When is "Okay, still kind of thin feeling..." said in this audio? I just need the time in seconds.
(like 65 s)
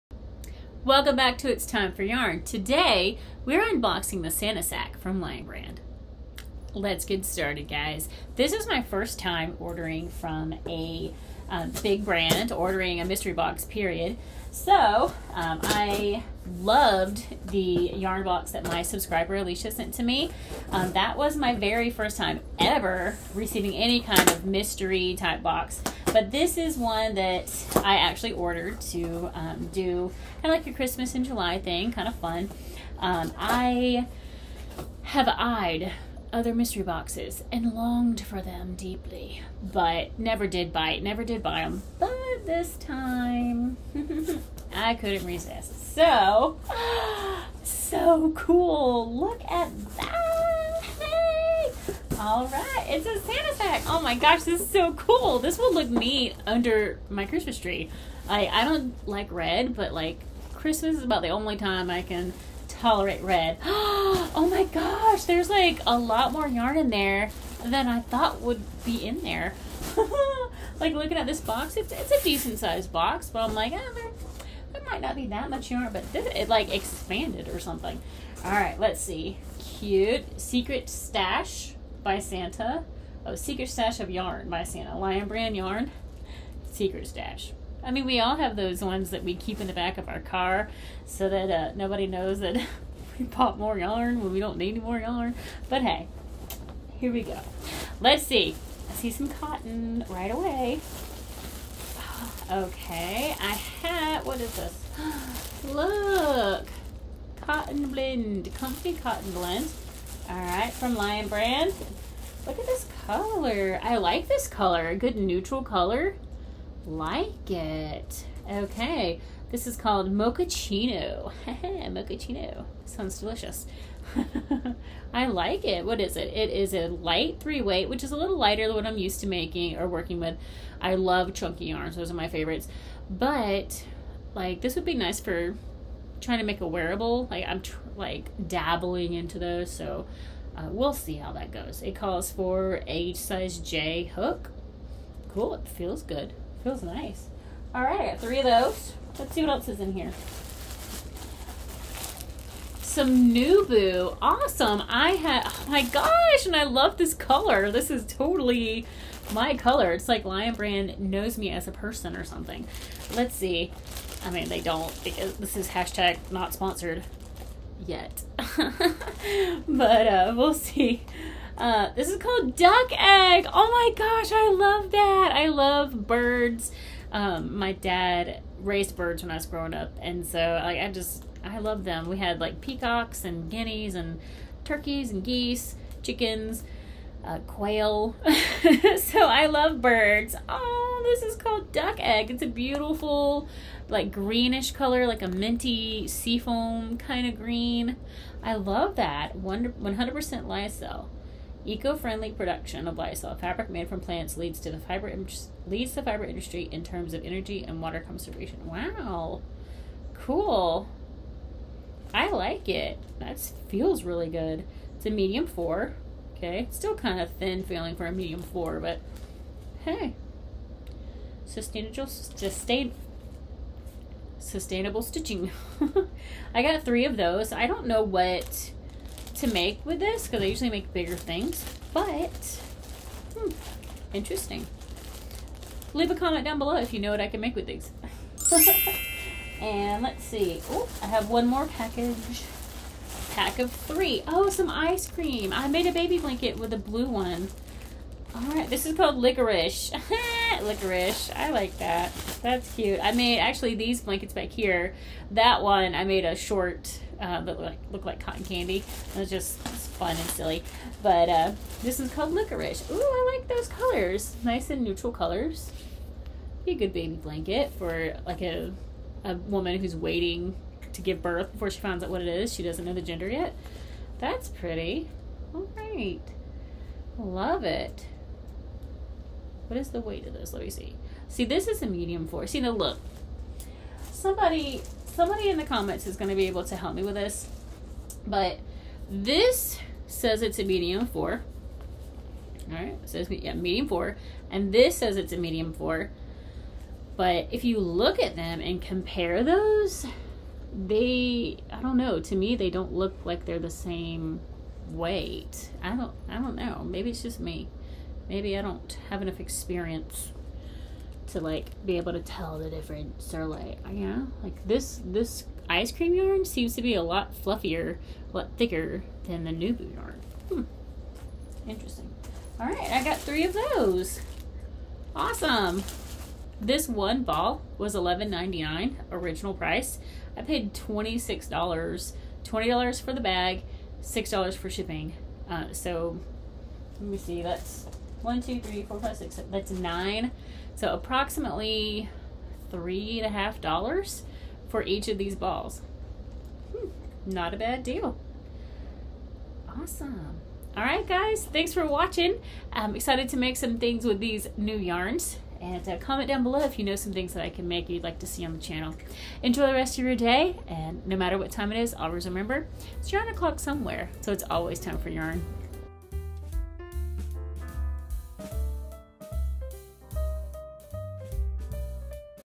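216 s.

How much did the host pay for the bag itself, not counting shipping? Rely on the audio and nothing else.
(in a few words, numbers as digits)
$20.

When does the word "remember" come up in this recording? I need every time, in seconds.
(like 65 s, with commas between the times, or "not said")
362 s.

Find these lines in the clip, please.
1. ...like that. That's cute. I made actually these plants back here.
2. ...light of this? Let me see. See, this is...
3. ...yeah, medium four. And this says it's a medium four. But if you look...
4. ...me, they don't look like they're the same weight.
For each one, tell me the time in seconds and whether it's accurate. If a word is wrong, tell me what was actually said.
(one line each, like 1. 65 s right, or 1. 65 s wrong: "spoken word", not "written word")
1. 251 s wrong: "blankets", not "plants"
2. 280 s wrong: "weight", not "light"
3. 293 s right
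4. 302 s right.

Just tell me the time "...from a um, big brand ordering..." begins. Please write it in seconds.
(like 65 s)
10 s.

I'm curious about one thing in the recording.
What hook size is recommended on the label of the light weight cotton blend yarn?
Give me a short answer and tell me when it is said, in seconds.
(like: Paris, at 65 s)
Size J, at 143 s.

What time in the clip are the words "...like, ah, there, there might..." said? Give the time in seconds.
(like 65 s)
73 s.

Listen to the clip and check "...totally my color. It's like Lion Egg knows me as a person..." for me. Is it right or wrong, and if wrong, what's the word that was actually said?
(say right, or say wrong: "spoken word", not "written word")
wrong: "Brand", not "Egg".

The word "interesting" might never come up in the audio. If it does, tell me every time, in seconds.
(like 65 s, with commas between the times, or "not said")
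234 s, 321 s.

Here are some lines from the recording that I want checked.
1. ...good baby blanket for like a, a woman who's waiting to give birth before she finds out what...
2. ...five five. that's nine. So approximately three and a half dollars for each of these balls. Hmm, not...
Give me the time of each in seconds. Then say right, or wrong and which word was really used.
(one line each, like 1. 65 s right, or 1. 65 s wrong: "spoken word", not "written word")
1. 266 s right
2. 338 s wrong: "six", not "five".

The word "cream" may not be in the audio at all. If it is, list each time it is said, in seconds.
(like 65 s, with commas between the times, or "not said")
245 s, 315 s.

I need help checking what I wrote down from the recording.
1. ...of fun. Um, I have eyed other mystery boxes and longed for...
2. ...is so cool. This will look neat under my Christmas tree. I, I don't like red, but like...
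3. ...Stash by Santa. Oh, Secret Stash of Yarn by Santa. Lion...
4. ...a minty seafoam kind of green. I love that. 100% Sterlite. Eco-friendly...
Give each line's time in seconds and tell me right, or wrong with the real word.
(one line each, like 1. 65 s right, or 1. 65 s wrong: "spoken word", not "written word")
1. 32 s right
2. 54 s right
3. 80 s right
4. 195 s wrong: "Lyocell", not "Sterlite".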